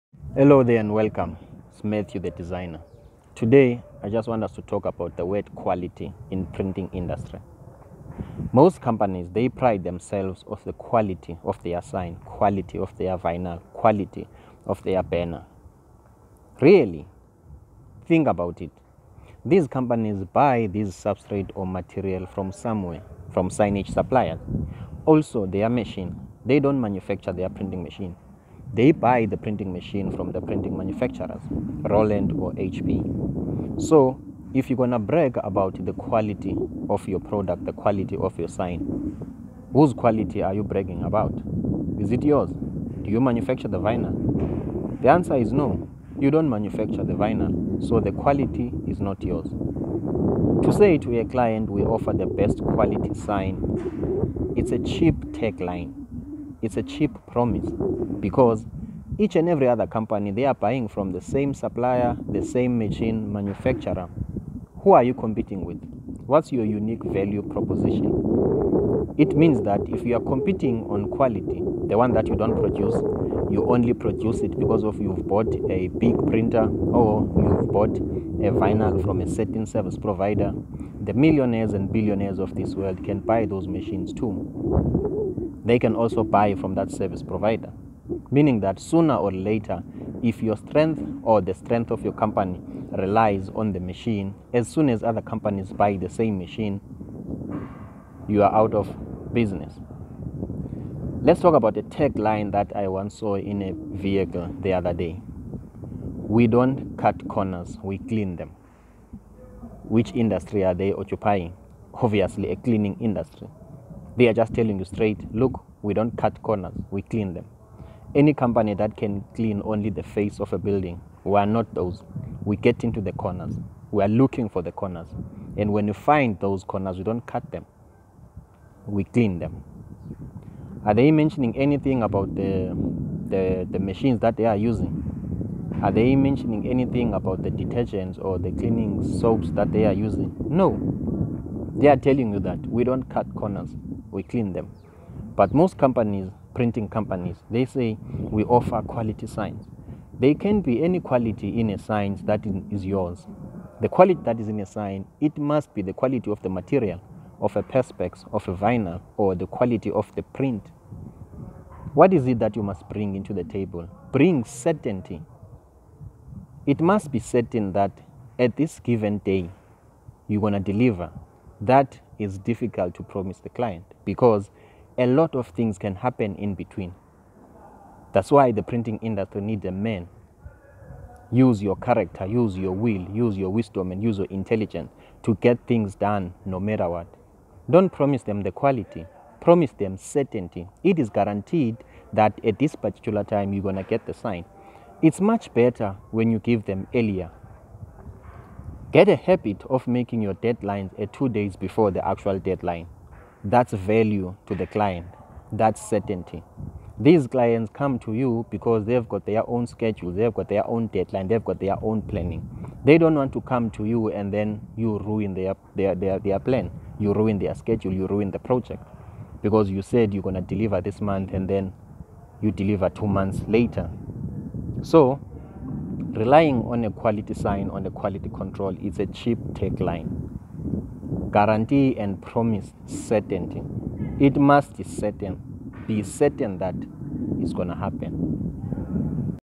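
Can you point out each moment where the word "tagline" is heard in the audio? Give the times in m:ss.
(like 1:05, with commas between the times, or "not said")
0:55, 1:41, 3:49.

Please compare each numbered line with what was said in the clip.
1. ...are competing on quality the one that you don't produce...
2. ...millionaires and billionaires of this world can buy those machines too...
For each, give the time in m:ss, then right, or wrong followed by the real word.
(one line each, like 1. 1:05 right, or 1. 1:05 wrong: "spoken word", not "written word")
1. 1:10 right
2. 1:21 right.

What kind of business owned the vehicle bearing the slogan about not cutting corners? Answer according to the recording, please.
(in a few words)
cleaning industry.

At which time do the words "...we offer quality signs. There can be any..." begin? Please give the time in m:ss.
2:28.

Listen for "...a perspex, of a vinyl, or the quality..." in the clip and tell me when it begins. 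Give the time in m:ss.
2:37.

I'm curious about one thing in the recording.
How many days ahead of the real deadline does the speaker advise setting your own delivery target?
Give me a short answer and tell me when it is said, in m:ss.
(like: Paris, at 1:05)
2 days, at 3:21.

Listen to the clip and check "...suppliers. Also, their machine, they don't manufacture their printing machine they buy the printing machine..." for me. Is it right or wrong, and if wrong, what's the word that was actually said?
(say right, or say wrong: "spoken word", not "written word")
right.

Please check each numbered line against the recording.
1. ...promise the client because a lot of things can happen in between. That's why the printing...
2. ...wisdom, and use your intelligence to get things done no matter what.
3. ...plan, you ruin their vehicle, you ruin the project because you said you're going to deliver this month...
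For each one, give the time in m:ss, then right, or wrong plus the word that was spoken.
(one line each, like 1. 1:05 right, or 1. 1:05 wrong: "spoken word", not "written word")
1. 2:53 right
2. 3:03 right
3. 3:36 wrong: "schedule", not "vehicle".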